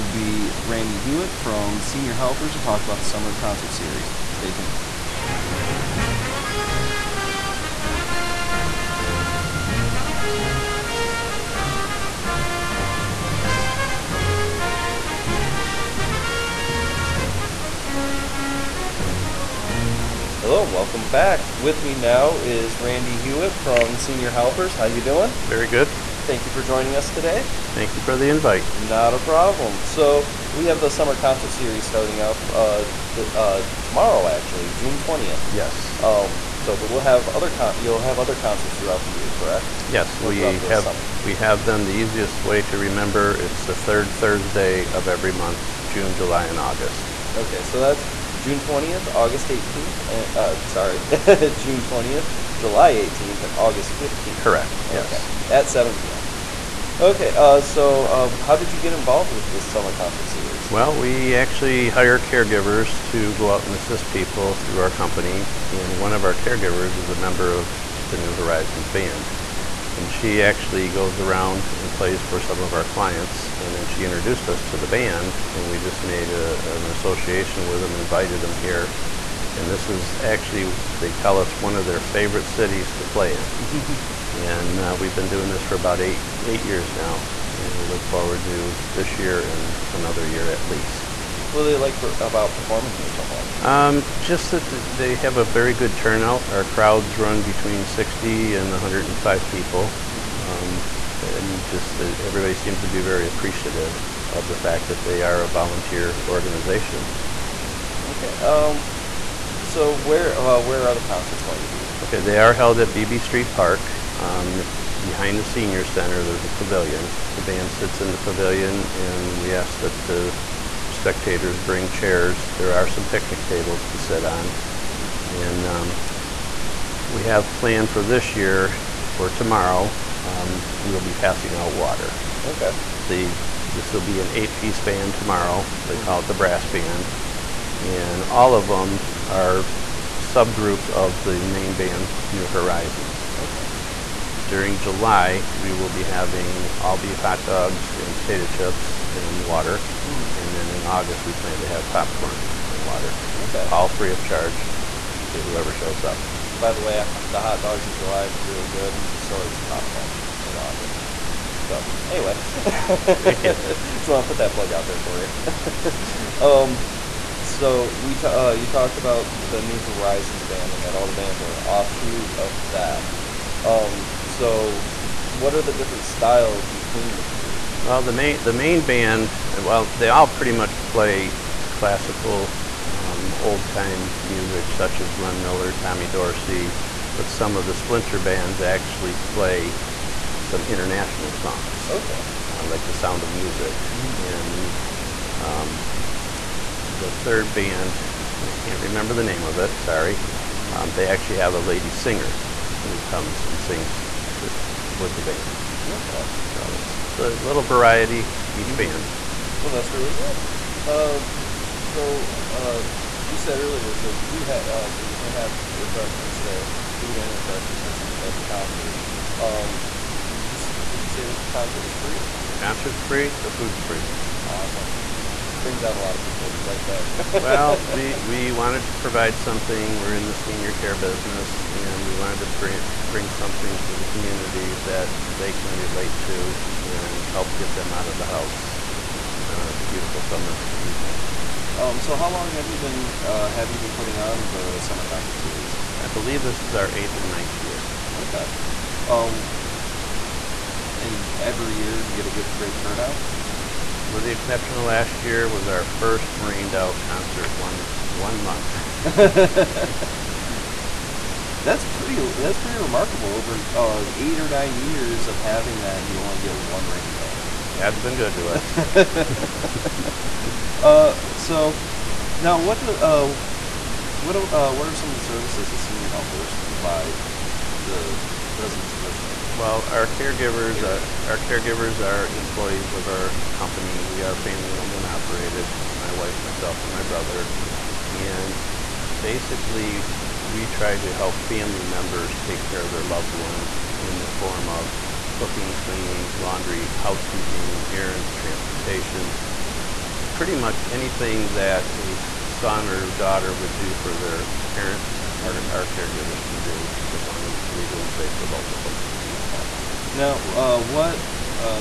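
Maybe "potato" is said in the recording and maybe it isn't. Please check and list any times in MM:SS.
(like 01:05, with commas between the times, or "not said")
02:28.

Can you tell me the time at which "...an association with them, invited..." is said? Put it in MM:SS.
01:16.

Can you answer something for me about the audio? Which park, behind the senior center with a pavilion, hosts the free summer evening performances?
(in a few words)
Beebe Street Park.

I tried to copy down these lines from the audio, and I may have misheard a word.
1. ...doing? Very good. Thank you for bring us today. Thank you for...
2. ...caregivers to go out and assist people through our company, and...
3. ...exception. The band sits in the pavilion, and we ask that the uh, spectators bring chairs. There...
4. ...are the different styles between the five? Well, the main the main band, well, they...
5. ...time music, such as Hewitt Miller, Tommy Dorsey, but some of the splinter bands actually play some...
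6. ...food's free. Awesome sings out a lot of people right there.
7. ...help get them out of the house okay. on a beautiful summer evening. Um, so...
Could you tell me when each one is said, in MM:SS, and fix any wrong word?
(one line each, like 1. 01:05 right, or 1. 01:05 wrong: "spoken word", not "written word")
1. 00:25 wrong: "joining", not "bring"
2. 01:02 right
3. 01:56 wrong: "pavilion", not "exception"
4. 02:55 wrong: "three", not "five"
5. 03:03 wrong: "Glenn", not "Hewitt"
6. 03:43 wrong: "brings", not "sings"
7. 03:57 right.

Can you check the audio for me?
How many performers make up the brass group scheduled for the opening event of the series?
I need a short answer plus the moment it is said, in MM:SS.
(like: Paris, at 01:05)
8, at 02:14.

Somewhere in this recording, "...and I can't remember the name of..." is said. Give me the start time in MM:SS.
03:18.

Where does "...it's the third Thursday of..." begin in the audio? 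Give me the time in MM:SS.
00:43.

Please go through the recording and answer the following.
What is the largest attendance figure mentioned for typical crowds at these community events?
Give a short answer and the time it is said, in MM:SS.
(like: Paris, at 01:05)
105, at 01:38.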